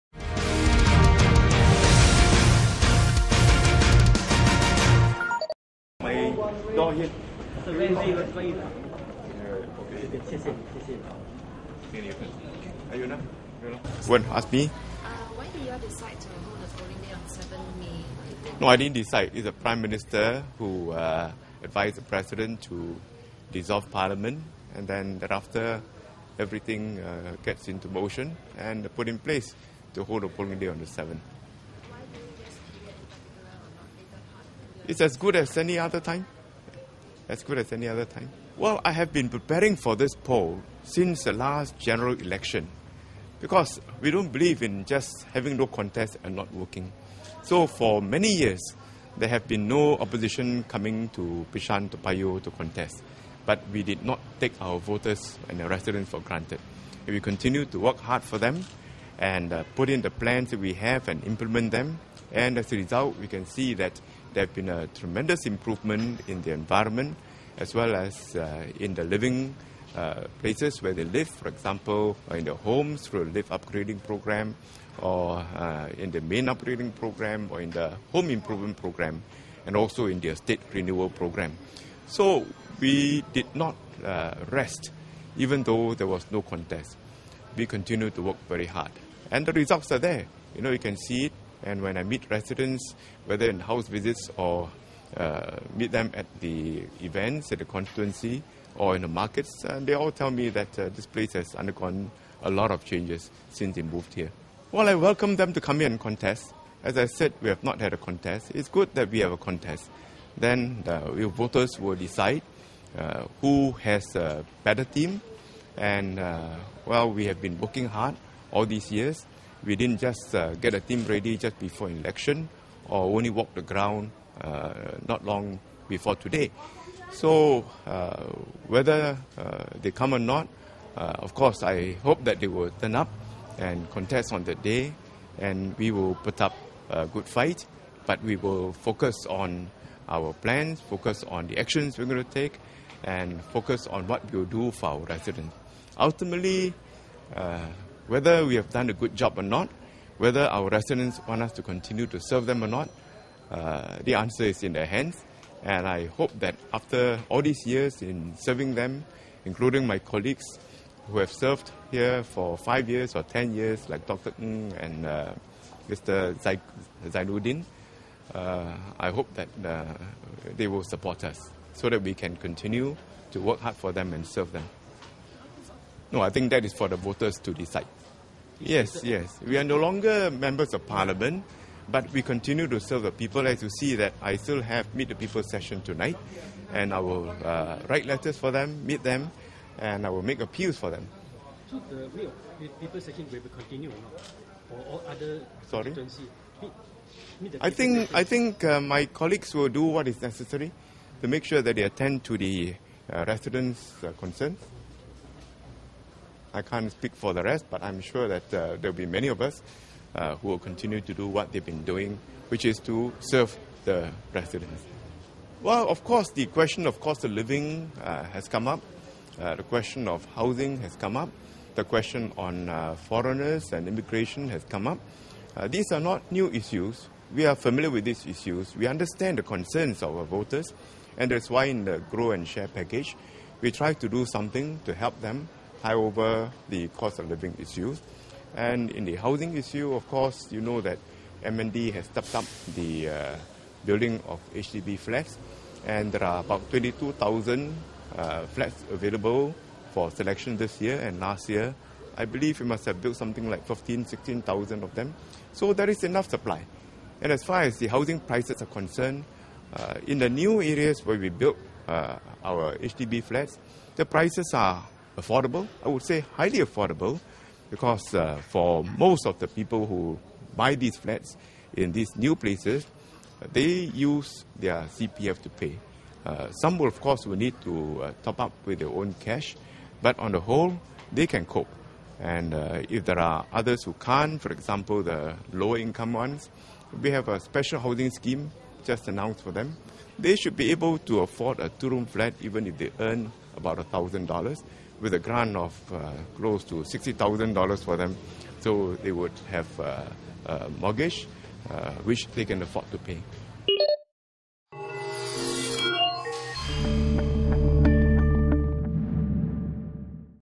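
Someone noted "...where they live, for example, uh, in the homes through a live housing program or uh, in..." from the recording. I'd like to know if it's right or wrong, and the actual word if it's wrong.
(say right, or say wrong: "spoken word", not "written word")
wrong: "upgrading", not "housing".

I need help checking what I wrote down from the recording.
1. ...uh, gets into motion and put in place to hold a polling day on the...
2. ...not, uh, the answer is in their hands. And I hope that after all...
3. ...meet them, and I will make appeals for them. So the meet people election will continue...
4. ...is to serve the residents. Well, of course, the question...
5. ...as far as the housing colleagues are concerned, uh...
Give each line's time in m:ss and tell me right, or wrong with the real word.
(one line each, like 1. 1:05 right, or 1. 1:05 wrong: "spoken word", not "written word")
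1. 0:26 right
2. 2:32 right
3. 3:08 wrong: "session", not "election"
4. 3:32 right
5. 4:17 wrong: "prices", not "colleagues".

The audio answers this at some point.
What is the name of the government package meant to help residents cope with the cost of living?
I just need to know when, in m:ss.
3:51.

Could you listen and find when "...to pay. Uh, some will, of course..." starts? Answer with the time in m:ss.
4:35.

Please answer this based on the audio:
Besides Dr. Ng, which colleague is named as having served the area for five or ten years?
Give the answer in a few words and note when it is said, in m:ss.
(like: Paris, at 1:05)
Mr. Zainudin, at 2:45.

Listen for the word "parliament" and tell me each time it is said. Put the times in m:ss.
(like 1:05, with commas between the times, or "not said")
0:23, 3:00.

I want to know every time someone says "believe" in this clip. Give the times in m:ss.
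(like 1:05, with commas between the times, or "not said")
0:44, 4:12.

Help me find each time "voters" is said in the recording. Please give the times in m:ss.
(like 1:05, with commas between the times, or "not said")
0:54, 1:51, 2:56, 3:50.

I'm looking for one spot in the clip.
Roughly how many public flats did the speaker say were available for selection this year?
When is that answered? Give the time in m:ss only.
4:06.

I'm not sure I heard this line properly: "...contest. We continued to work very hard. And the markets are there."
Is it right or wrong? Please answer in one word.
wrong.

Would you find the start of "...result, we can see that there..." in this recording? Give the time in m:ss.
1:02.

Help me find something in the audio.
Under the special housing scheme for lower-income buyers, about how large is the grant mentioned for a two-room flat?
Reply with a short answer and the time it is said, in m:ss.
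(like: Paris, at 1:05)
$60,000, at 4:56.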